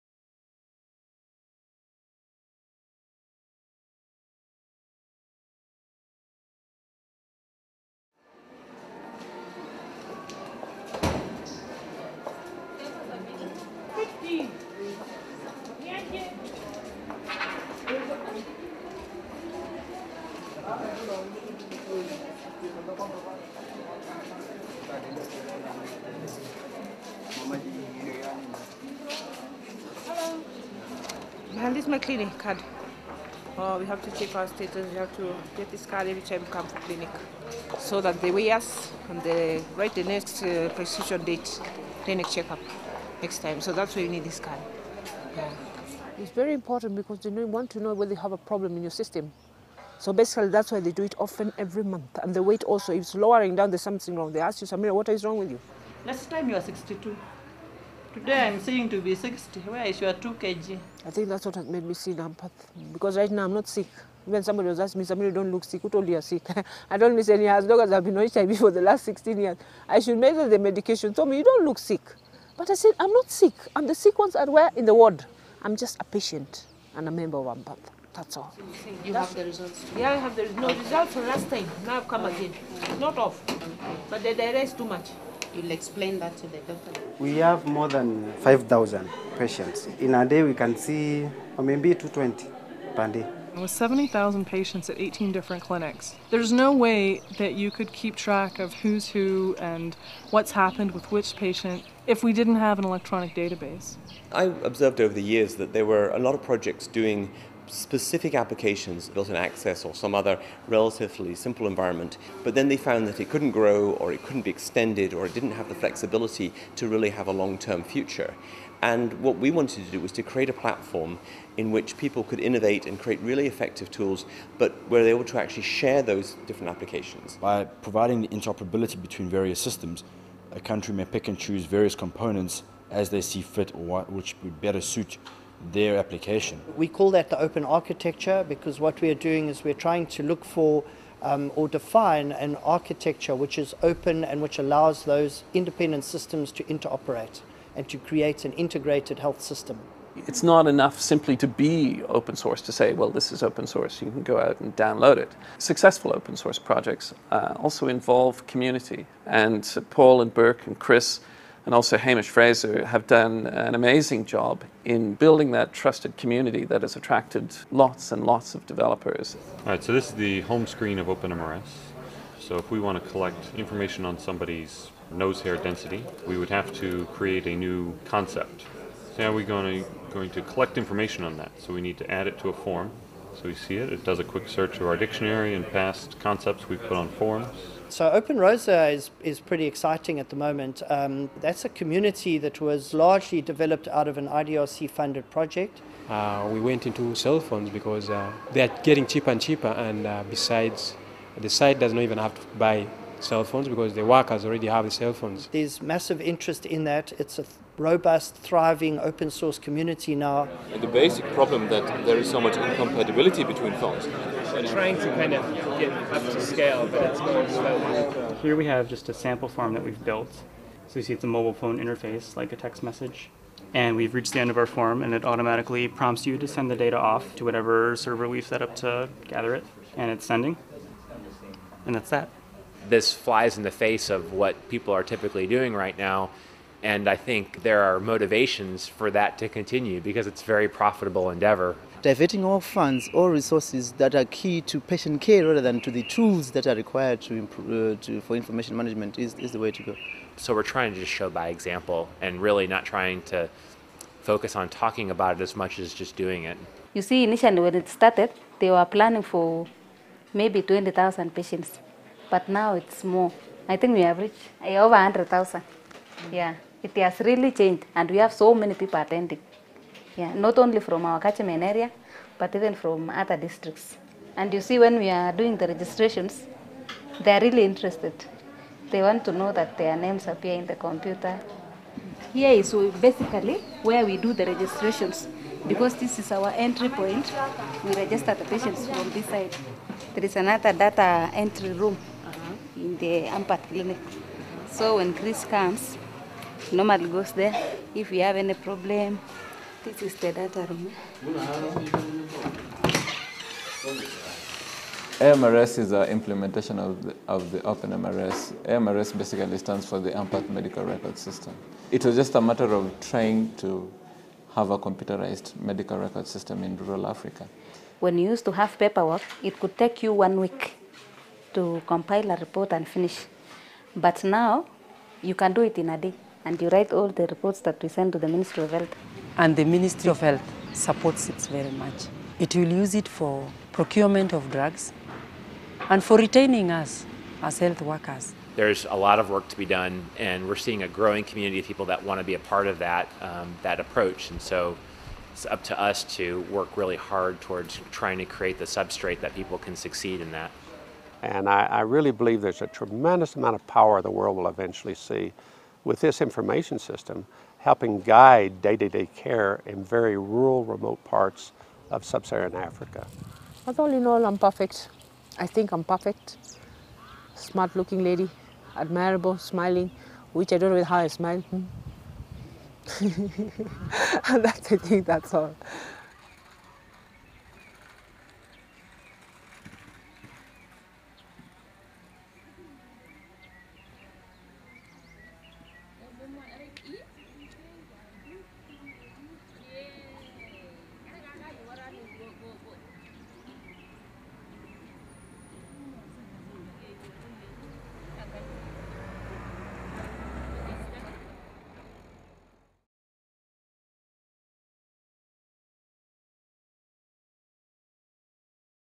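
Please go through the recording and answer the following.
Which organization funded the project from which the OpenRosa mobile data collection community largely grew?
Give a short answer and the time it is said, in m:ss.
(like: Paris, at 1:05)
IDRC, at 3:14.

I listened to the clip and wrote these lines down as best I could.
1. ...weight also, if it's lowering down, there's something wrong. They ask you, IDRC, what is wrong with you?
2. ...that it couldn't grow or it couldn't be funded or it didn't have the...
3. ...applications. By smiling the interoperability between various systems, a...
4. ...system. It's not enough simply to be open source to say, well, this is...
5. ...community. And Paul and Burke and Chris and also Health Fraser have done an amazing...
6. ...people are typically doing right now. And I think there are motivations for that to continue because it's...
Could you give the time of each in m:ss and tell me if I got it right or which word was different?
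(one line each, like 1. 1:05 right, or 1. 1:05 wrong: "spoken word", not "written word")
1. 0:52 wrong: "Samira", not "IDRC"
2. 1:53 wrong: "extended", not "funded"
3. 2:06 wrong: "providing", not "smiling"
4. 2:29 right
5. 2:38 wrong: "Hamish", not "Health"
6. 3:54 right.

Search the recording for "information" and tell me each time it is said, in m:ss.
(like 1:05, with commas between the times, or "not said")
2:53, 3:00, 4:08, 5:56.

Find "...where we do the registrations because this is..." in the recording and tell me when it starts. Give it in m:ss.
4:43.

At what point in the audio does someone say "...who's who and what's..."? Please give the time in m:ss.
1:38.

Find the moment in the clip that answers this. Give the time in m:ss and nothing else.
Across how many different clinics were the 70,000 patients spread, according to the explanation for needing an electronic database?
1:34.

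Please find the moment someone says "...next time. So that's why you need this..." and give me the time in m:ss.
0:43.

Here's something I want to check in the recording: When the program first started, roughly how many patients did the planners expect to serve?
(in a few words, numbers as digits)
20,000.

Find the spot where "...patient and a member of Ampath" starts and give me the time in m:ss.
1:16.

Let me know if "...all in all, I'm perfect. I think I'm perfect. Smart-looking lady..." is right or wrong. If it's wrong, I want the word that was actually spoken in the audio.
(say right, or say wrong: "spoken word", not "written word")
right.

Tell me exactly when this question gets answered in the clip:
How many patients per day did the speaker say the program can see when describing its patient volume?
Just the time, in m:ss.
1:31.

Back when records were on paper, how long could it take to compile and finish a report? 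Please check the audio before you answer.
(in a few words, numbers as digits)
one week.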